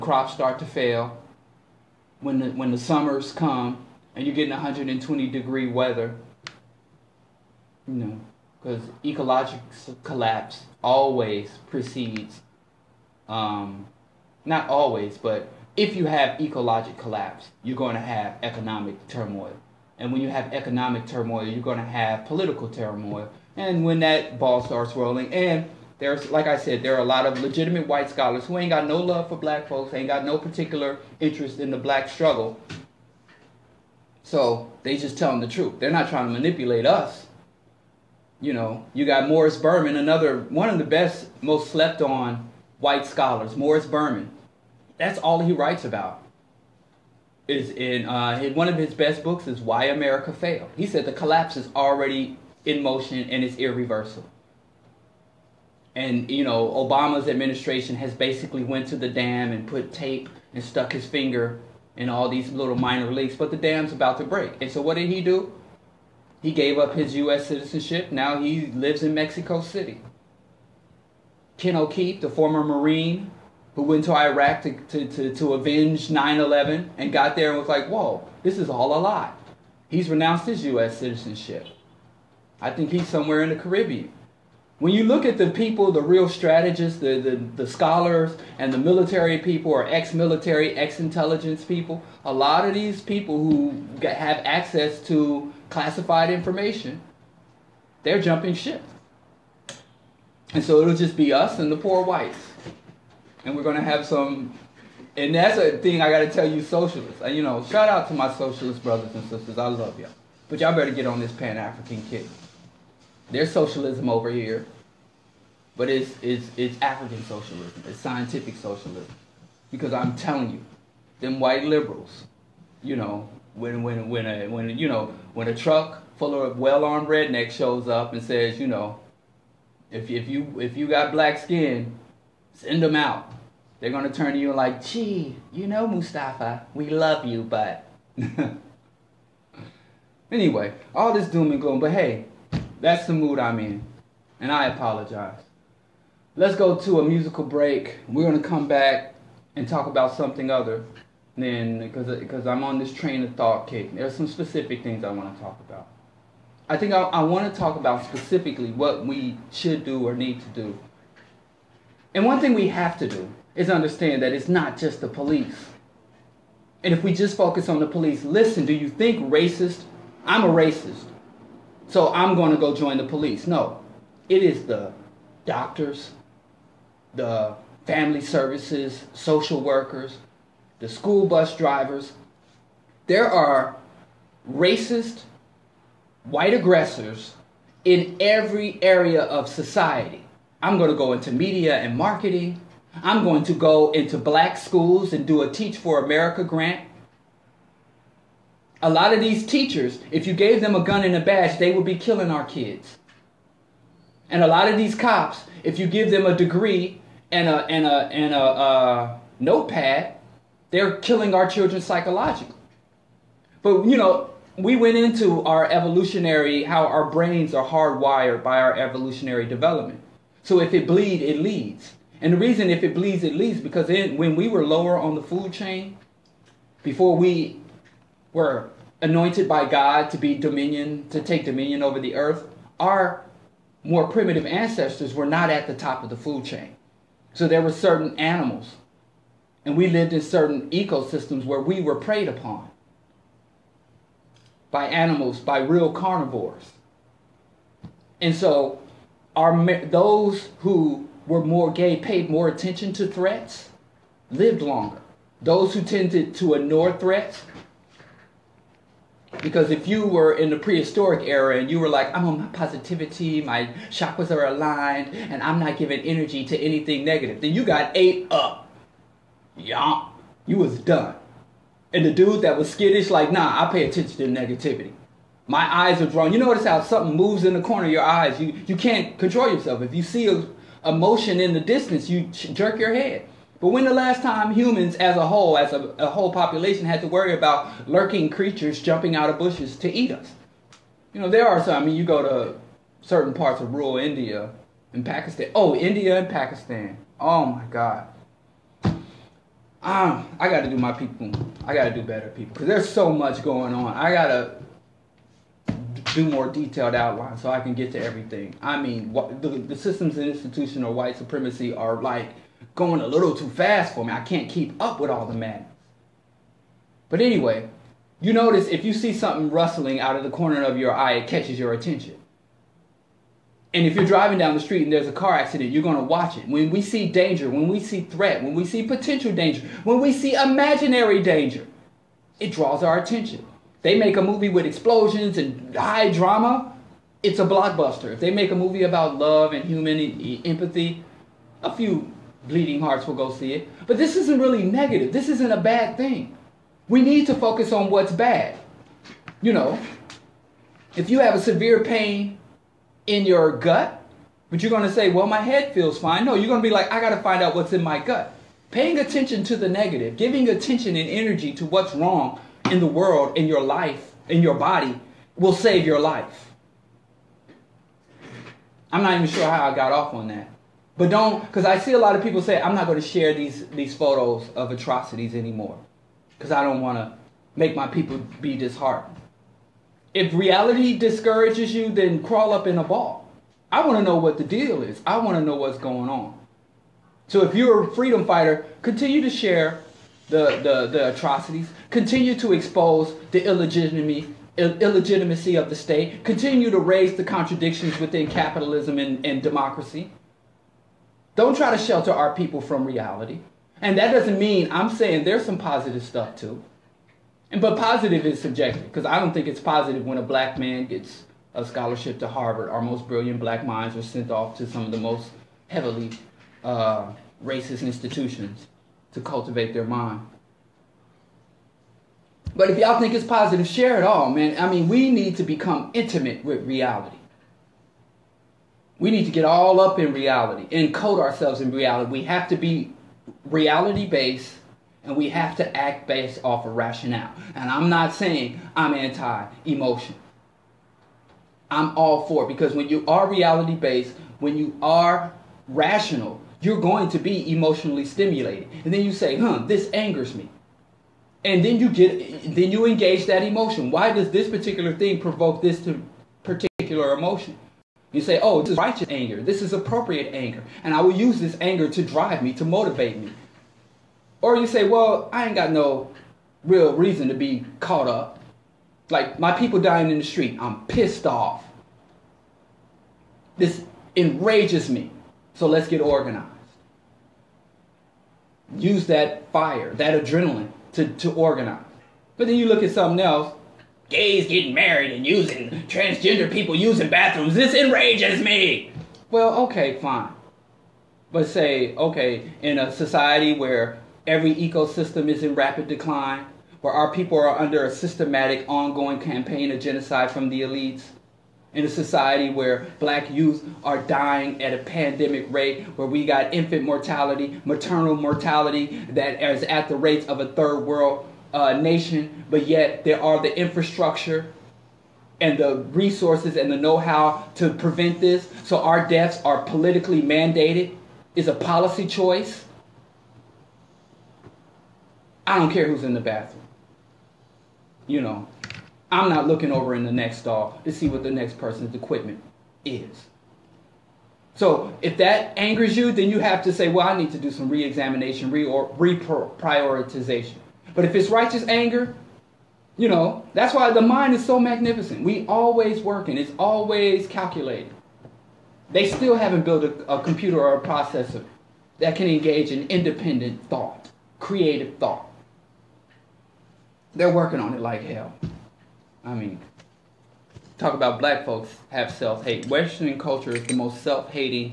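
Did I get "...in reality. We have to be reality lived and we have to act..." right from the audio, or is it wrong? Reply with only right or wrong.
wrong.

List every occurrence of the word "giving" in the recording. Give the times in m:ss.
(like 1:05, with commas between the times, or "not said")
4:25, 6:00.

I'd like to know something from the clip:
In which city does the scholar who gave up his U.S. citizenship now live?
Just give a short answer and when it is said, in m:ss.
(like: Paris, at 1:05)
Mexico City, at 1:09.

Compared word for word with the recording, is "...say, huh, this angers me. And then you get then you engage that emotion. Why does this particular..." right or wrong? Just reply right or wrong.
right.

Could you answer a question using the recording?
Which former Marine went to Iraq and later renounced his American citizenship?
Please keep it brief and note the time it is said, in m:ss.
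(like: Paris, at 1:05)
Ken O'Keefe, at 1:11.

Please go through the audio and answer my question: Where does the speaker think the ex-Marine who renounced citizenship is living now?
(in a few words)
the Caribbean.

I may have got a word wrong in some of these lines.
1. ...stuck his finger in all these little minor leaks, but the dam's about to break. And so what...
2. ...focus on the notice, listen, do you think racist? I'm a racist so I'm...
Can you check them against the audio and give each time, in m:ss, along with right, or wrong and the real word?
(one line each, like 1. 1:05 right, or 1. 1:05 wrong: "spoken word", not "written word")
1. 1:00 right
2. 2:47 wrong: "police", not "notice".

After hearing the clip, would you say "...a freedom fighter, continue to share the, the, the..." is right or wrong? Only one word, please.
right.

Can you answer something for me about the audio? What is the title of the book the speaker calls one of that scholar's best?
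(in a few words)
Why America Failed.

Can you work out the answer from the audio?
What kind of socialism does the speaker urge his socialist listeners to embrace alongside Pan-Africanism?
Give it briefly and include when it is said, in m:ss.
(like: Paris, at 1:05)
African socialism, at 1:56.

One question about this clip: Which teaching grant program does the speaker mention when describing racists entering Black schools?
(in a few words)
Teach for America.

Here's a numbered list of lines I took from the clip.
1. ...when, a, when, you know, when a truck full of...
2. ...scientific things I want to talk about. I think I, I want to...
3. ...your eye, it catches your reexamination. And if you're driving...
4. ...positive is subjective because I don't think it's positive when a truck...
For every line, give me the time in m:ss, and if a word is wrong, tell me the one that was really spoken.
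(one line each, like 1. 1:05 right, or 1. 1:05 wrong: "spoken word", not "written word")
1. 2:04 right
2. 2:34 wrong: "specific", not "scientific"
3. 5:20 wrong: "attention", not "reexamination"
4. 6:47 wrong: "black", not "truck".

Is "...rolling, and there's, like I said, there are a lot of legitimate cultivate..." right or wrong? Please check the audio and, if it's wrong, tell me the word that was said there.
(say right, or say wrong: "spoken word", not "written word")
wrong: "white", not "cultivate".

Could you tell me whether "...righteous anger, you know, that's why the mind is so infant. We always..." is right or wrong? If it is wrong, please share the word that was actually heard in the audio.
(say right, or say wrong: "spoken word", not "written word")
wrong: "magnificent", not "infant".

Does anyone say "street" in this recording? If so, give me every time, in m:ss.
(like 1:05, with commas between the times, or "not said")
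5:24, 7:50.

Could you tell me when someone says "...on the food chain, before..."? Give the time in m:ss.
3:44.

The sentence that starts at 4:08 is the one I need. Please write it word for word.
And so our, those who were more gay paid more attention to threats, lived longer.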